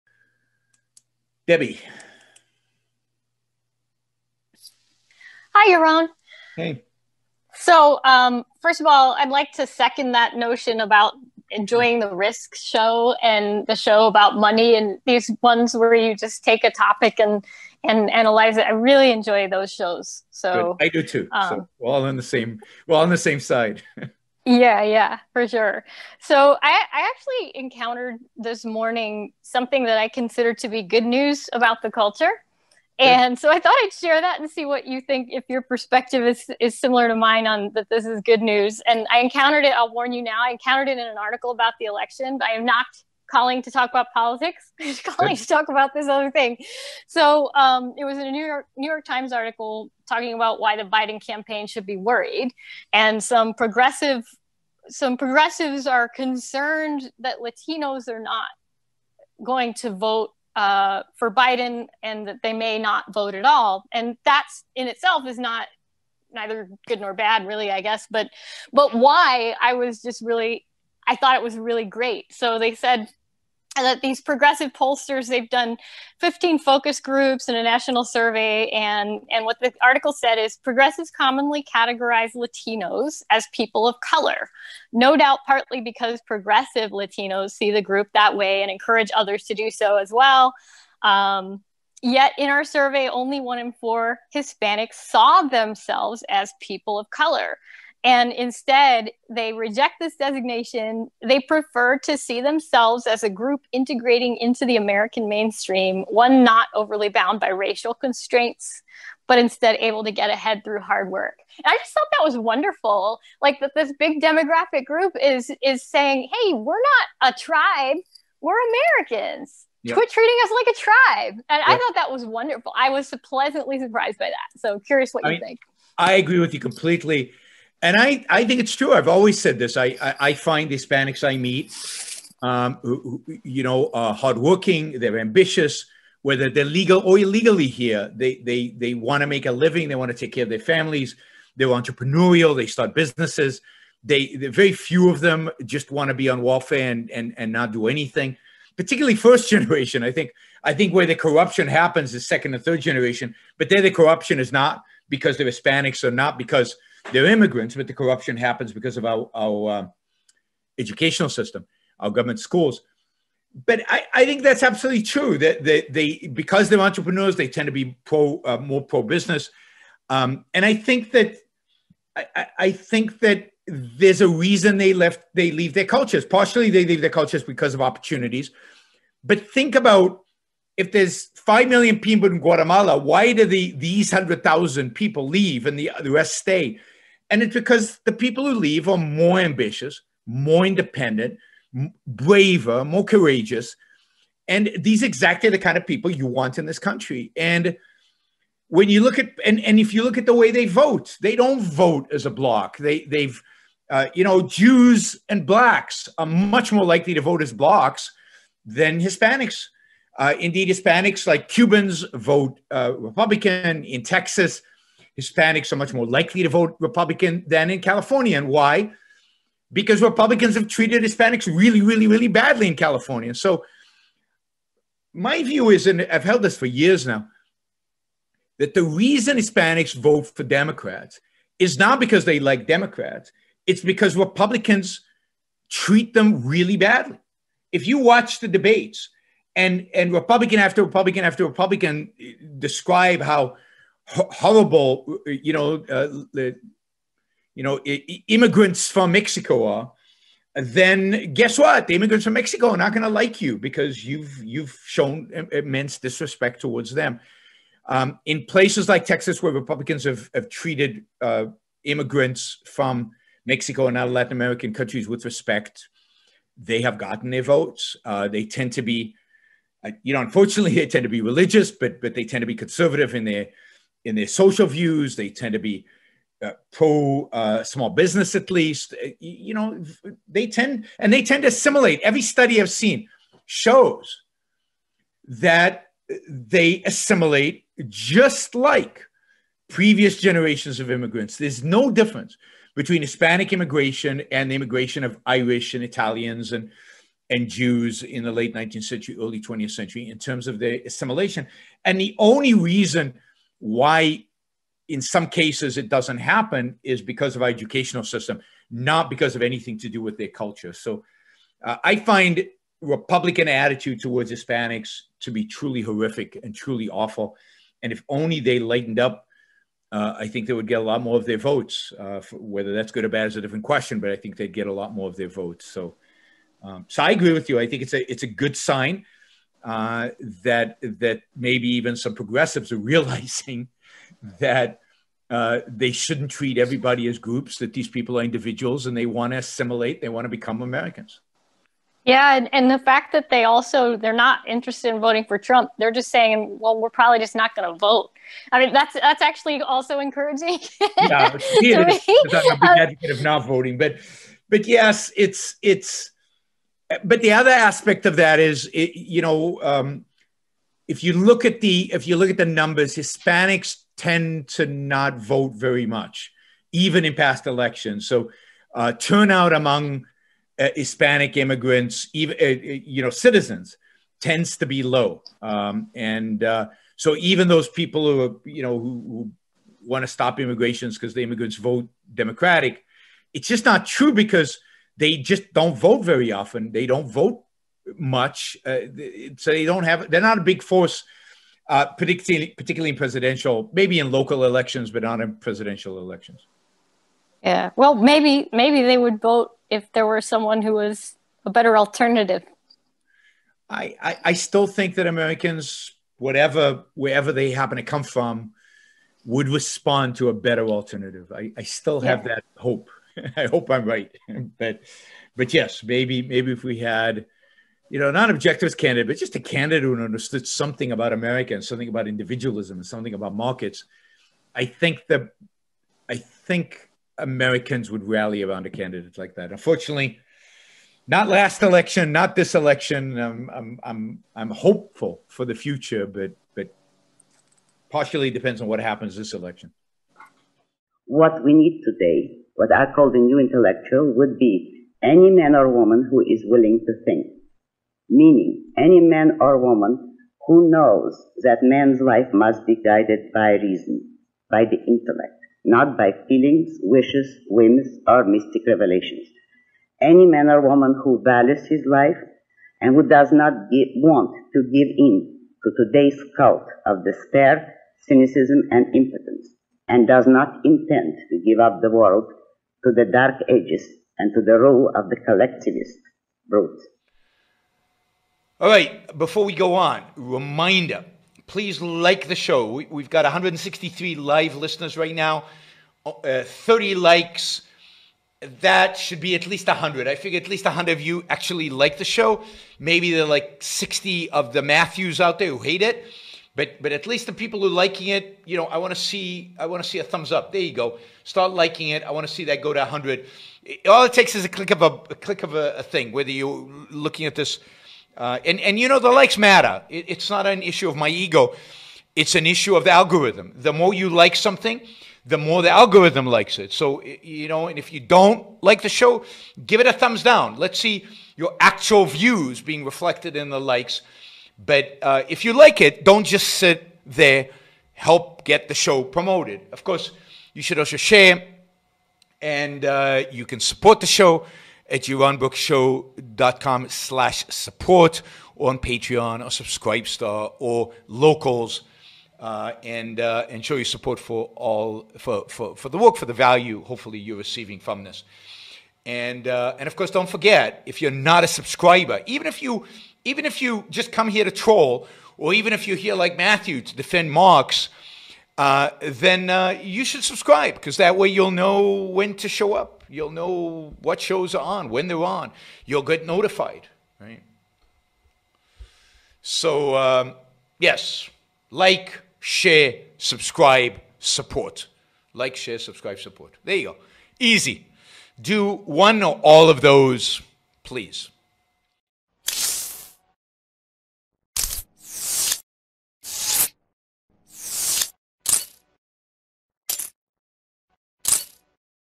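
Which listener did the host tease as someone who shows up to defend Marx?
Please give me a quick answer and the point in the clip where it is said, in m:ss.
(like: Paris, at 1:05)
Matthew, at 9:16.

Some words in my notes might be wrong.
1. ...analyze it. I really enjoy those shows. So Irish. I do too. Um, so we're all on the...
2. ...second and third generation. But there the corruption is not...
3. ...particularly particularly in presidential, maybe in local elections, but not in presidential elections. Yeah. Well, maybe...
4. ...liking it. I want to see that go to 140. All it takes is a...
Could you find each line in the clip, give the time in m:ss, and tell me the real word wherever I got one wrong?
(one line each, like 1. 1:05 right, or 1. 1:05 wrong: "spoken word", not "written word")
1. 0:18 wrong: "Good", not "Irish"
2. 2:32 right
3. 6:32 right
4. 8:21 wrong: "100", not "140".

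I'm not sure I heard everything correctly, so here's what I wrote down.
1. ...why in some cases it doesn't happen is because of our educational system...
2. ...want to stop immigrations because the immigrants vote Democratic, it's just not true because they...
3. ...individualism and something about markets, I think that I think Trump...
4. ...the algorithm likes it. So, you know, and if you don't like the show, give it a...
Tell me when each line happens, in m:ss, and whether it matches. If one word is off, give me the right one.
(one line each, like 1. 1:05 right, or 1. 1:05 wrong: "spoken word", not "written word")
1. 5:03 right
2. 6:19 right
3. 7:02 wrong: "Americans", not "Trump"
4. 8:35 right.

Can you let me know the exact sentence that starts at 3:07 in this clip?
And it's because the people who leave are more ambitious, more independent, braver, more courageous.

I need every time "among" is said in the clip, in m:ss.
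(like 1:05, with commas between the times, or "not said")
6:09.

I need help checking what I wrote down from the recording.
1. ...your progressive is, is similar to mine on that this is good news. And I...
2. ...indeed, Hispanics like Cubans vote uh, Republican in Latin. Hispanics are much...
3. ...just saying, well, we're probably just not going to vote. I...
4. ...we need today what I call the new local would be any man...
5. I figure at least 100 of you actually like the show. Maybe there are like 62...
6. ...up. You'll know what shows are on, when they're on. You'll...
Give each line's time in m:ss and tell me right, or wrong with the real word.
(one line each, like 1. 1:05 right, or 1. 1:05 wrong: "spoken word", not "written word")
1. 0:35 wrong: "perspective", not "progressive"
2. 3:30 wrong: "Texas", not "Latin"
3. 5:45 right
4. 7:21 wrong: "intellectual", not "local"
5. 8:10 wrong: "60", not "62"
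6. 9:22 right.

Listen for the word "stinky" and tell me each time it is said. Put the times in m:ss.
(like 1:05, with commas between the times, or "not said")
not said.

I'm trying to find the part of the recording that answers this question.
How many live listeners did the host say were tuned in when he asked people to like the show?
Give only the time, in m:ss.
8:03.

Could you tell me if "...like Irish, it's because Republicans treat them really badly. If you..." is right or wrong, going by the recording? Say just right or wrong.
wrong.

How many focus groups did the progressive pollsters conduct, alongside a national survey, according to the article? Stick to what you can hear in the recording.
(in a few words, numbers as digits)
15.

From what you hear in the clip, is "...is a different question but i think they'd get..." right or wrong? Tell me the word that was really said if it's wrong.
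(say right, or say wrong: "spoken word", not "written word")
right.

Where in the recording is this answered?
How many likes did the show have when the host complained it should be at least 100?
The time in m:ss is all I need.
8:06.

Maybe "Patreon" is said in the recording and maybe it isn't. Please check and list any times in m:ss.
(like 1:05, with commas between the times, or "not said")
8:58.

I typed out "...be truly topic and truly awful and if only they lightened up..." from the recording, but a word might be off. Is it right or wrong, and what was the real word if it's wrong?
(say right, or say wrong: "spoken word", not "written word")
wrong: "horrific", not "topic".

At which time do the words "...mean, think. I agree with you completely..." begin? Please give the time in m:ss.
2:05.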